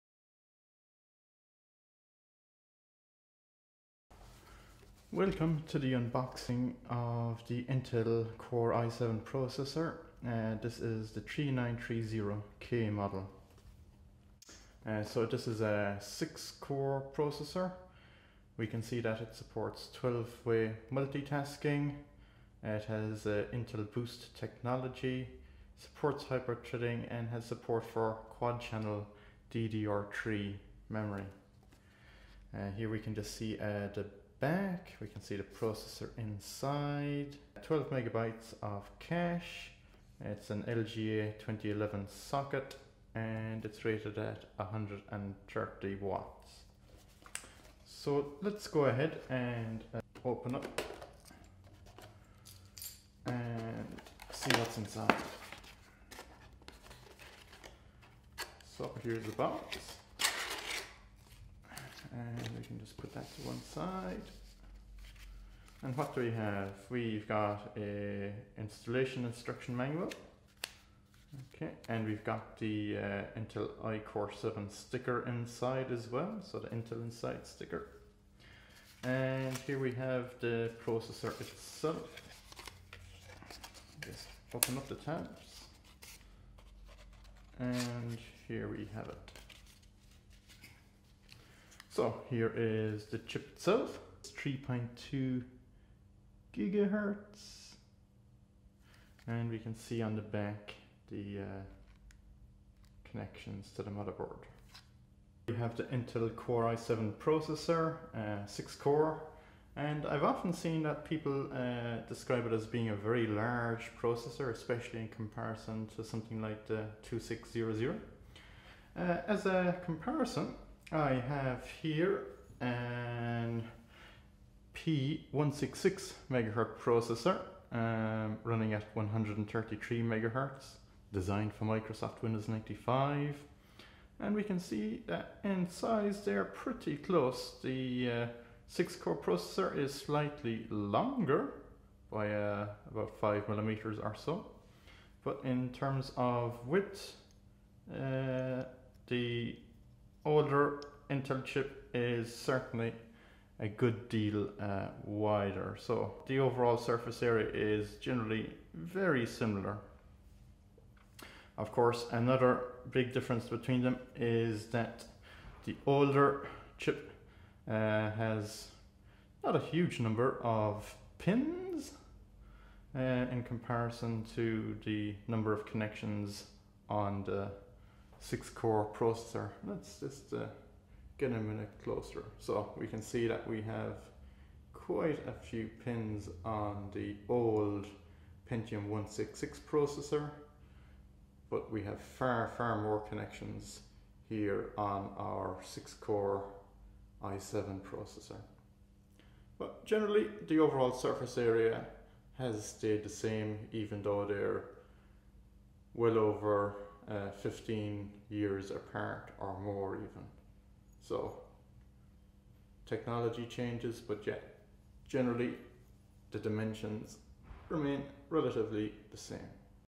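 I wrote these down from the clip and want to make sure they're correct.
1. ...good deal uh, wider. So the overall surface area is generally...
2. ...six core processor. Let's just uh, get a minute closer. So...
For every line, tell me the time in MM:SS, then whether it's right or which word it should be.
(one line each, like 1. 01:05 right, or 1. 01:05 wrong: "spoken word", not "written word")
1. 02:33 right
2. 02:58 right.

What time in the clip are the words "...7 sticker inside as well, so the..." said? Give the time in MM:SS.
01:14.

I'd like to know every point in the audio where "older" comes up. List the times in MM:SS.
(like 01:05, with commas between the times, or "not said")
02:30, 02:45.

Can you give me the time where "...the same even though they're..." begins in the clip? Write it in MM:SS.
03:23.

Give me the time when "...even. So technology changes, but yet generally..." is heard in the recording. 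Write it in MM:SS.
03:29.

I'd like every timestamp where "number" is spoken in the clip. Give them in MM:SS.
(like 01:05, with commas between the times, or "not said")
02:49, 02:55.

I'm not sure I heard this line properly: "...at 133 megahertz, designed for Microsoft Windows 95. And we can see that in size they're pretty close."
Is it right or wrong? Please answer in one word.
right.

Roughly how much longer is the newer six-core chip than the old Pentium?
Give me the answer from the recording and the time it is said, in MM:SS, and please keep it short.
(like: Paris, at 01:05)
About 5 mm, at 02:23.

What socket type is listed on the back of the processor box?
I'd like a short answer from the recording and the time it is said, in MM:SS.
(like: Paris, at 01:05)
LGA 2011, at 00:40.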